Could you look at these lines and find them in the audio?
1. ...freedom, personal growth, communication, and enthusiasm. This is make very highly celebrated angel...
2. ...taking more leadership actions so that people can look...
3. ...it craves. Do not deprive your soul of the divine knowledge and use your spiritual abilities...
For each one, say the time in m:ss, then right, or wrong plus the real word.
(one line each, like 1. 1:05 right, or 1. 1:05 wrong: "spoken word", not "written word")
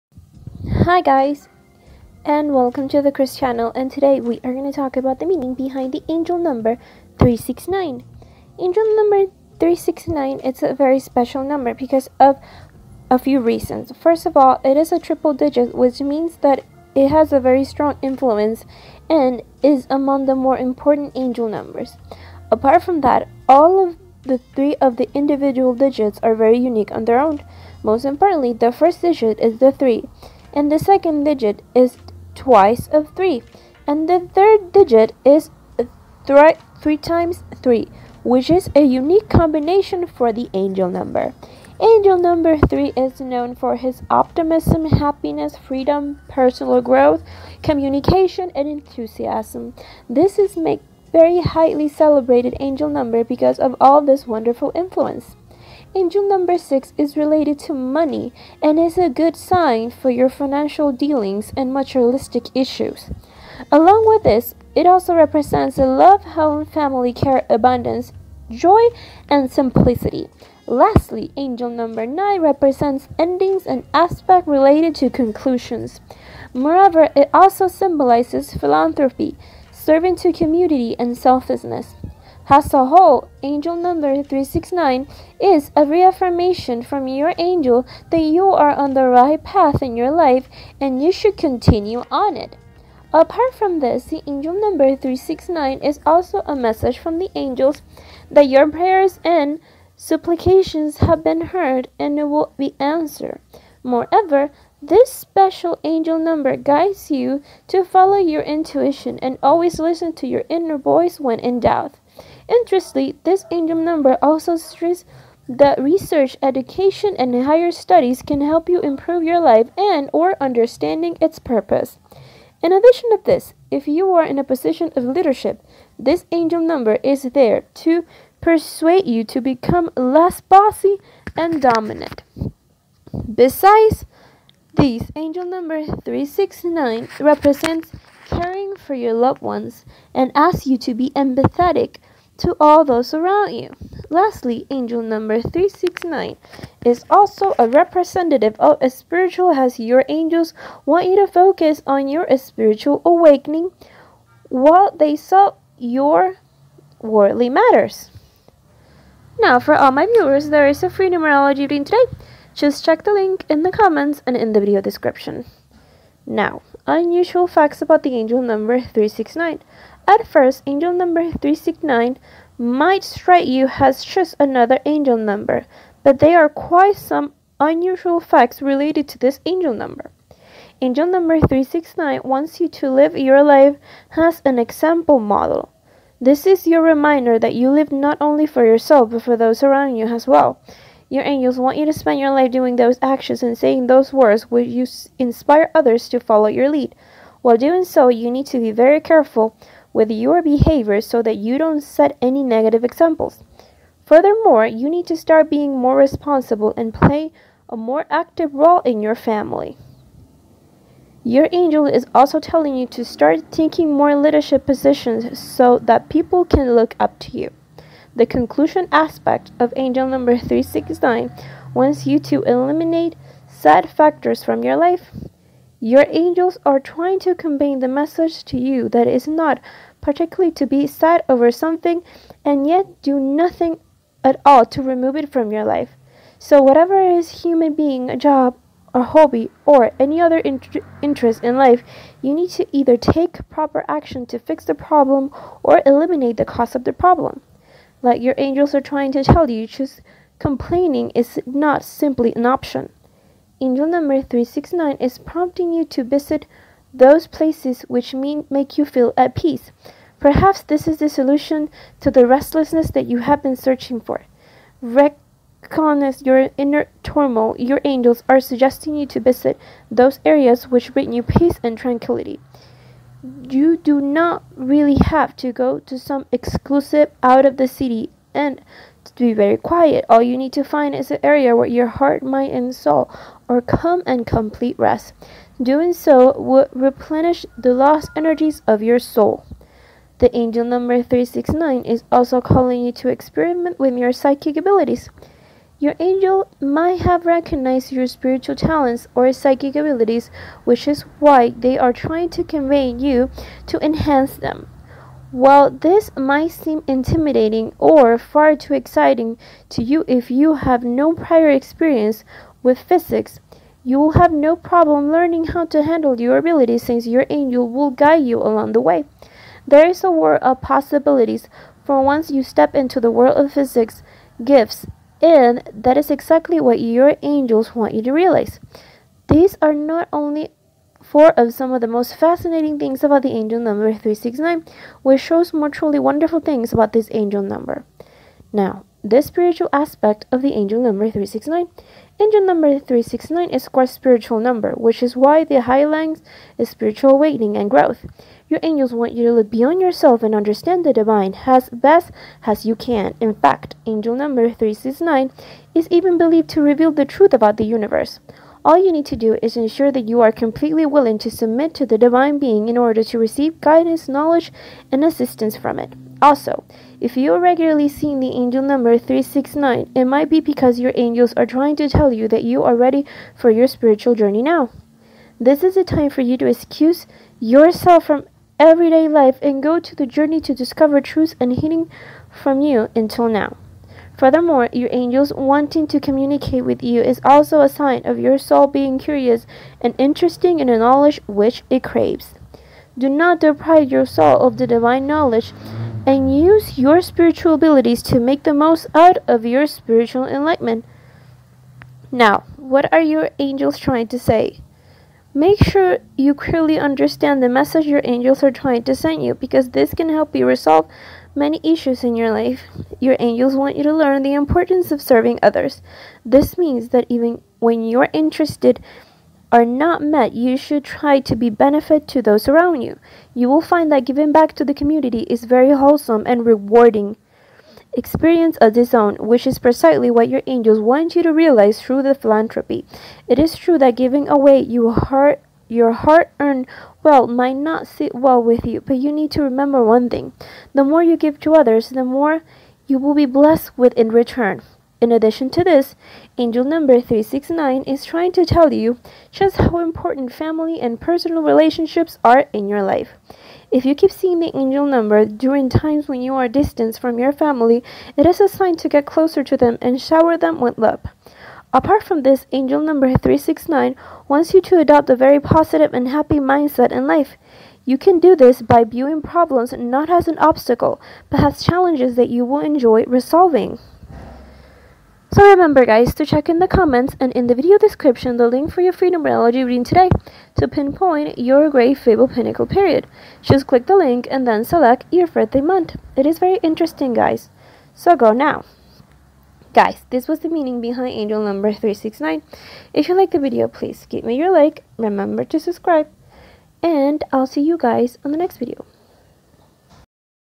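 1. 0:45 right
2. 3:33 wrong: "positions", not "actions"
3. 6:31 right.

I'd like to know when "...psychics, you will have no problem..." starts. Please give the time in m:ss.
5:12.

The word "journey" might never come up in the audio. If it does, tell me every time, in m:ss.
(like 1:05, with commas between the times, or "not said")
6:14, 6:20.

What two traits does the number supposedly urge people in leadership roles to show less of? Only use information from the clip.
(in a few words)
Bossy and dominant.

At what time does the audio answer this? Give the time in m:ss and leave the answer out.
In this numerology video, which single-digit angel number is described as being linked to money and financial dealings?
0:56.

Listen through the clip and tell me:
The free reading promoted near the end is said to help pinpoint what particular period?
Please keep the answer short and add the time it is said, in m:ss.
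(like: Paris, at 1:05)
Great Fable Pinnacle period, at 8:01.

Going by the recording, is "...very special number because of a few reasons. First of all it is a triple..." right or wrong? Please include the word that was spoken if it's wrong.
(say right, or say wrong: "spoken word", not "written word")
right.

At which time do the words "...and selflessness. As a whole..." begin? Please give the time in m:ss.
1:20.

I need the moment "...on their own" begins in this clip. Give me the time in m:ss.
0:26.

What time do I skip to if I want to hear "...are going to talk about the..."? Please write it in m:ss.
0:04.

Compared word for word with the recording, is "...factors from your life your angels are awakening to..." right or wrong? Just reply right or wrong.
wrong.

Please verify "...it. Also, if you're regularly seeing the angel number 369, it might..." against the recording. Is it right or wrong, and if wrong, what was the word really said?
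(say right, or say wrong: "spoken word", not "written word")
right.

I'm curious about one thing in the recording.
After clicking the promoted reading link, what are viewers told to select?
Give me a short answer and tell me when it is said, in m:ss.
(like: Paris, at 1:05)
Birthday month, at 8:05.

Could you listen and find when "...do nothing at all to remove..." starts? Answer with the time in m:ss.
3:53.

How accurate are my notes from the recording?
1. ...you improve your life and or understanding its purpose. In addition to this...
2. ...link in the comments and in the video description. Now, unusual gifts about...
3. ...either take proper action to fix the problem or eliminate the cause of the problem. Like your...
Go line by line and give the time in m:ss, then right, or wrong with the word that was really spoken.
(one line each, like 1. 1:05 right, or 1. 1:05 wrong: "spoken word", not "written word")
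1. 1:58 right
2. 2:43 wrong: "facts", not "gifts"
3. 4:02 right.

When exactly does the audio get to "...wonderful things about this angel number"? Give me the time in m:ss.
5:35.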